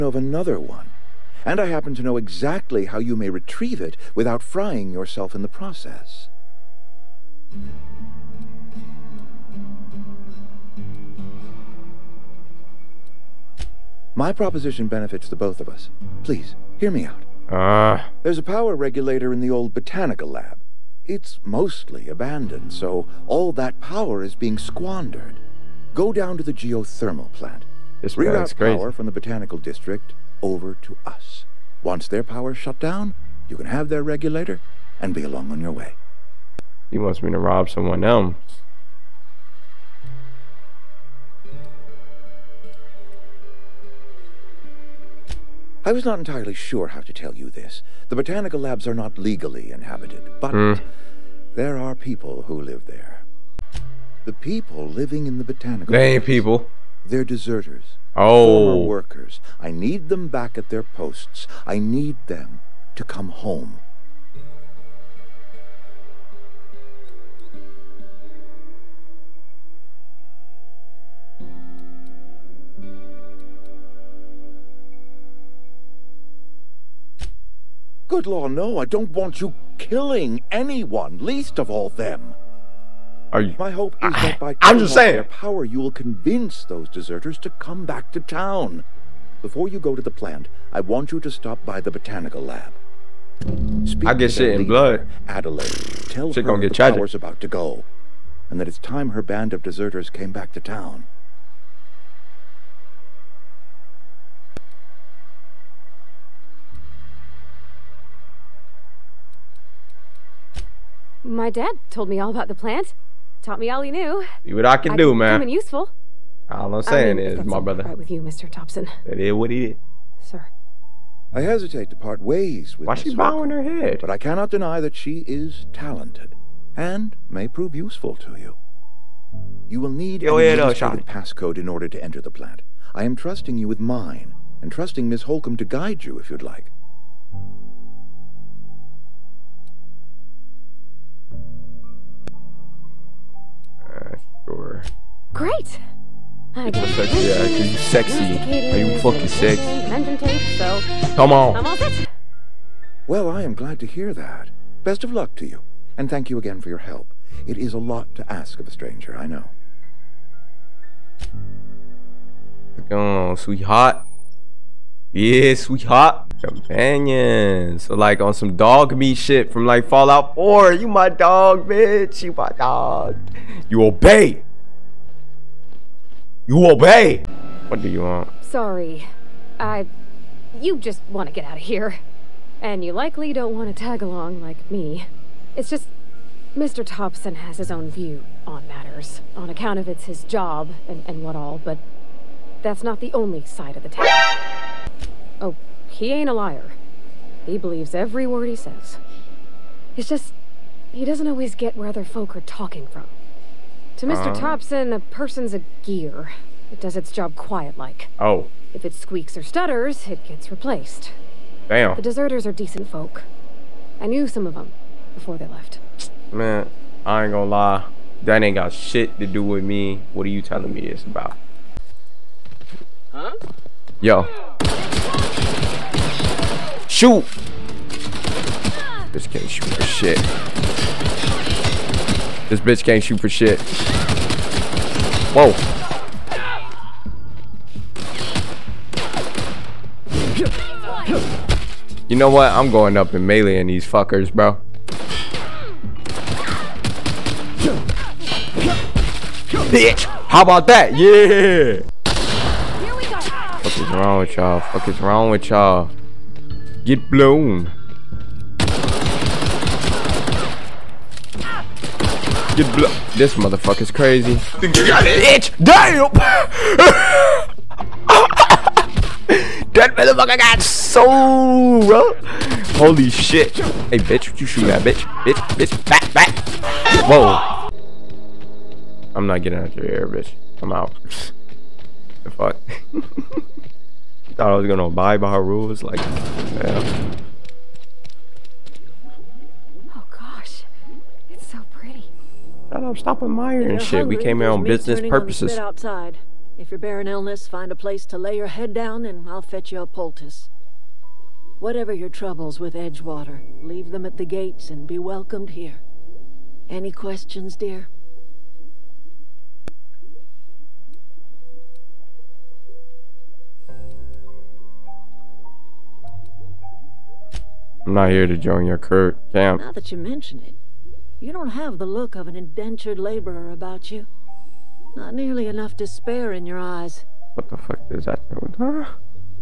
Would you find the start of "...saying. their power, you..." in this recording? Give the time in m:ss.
1:24.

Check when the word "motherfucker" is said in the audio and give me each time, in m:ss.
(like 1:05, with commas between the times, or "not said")
4:23, 4:29.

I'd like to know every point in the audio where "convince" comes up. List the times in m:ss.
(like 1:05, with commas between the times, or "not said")
1:25.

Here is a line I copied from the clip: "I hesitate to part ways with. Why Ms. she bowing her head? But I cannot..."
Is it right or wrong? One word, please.
right.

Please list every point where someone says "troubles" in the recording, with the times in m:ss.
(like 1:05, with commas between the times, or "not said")
5:02.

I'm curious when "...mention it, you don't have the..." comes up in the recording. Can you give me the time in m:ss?
5:19.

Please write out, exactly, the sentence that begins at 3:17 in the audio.
He believes every word he says.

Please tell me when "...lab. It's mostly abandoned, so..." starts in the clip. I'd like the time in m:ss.
0:20.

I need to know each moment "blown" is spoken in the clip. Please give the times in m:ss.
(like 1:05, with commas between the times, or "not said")
4:17, 4:22.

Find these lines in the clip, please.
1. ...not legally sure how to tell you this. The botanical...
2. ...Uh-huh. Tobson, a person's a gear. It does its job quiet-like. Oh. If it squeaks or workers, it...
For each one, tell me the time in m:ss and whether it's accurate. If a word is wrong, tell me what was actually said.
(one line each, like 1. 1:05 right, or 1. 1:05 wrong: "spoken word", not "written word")
1. 0:46 wrong: "entirely", not "legally"
2. 3:24 wrong: "stutters", not "workers".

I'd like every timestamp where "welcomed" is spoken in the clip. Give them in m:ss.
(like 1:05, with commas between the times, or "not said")
5:04.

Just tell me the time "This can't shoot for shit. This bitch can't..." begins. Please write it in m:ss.
3:49.